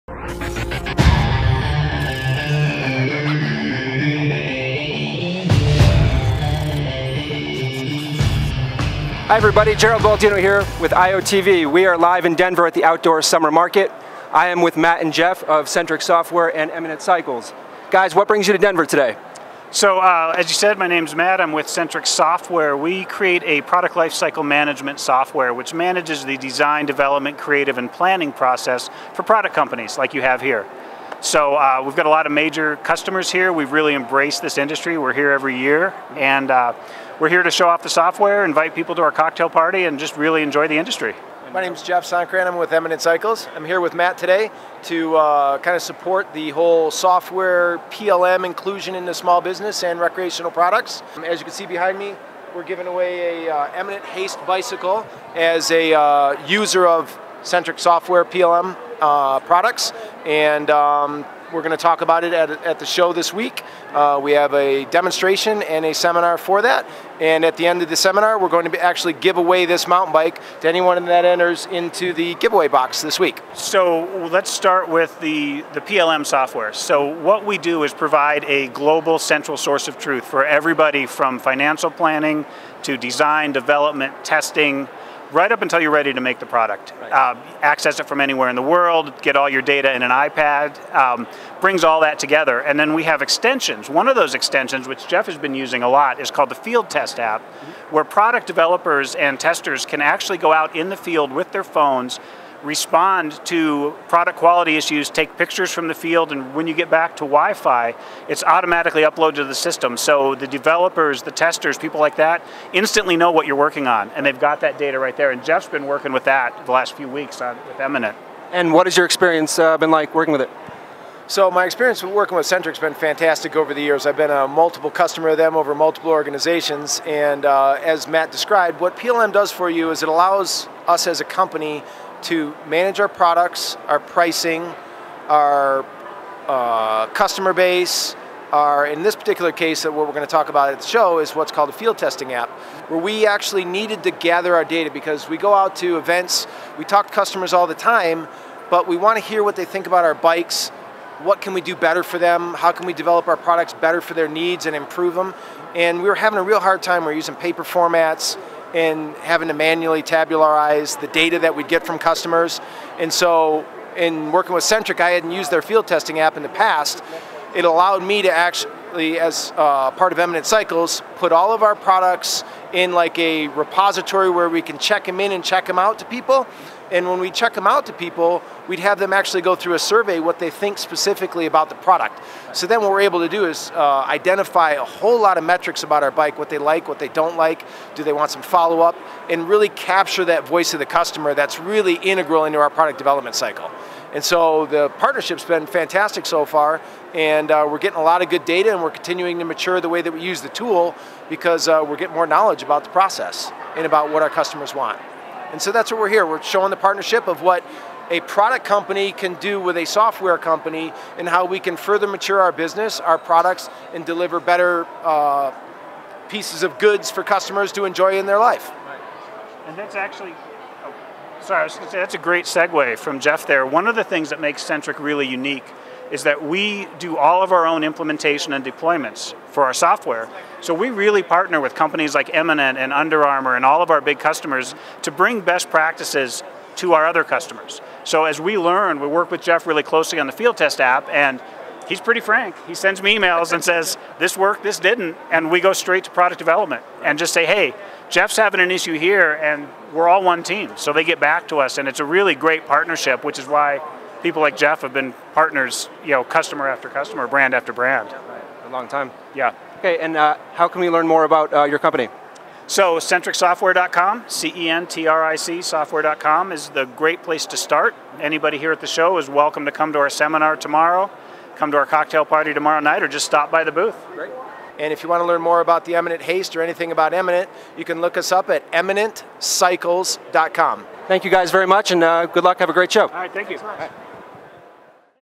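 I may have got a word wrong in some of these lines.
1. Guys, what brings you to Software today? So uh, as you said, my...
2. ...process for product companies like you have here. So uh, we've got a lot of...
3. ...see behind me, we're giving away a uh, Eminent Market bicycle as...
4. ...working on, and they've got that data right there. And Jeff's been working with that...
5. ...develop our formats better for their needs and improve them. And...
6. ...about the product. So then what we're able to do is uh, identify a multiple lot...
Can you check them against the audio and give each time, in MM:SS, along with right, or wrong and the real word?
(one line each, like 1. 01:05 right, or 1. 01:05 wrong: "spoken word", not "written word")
1. 00:17 wrong: "Denver", not "Software"
2. 00:28 right
3. 00:51 wrong: "Haste", not "Market"
4. 01:53 right
5. 02:32 wrong: "products", not "formats"
6. 03:01 wrong: "whole", not "multiple".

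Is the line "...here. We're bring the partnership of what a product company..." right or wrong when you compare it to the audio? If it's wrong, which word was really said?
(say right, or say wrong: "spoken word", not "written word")
wrong: "showing", not "bring".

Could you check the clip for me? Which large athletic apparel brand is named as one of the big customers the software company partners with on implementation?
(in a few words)
Under Armour.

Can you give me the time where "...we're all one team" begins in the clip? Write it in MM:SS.
04:09.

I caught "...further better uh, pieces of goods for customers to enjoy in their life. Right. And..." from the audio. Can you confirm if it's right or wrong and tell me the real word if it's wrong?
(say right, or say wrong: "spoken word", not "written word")
wrong: "deliver", not "further".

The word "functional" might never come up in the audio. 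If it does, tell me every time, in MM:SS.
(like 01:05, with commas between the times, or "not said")
not said.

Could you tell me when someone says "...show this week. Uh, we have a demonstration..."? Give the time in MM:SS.
01:02.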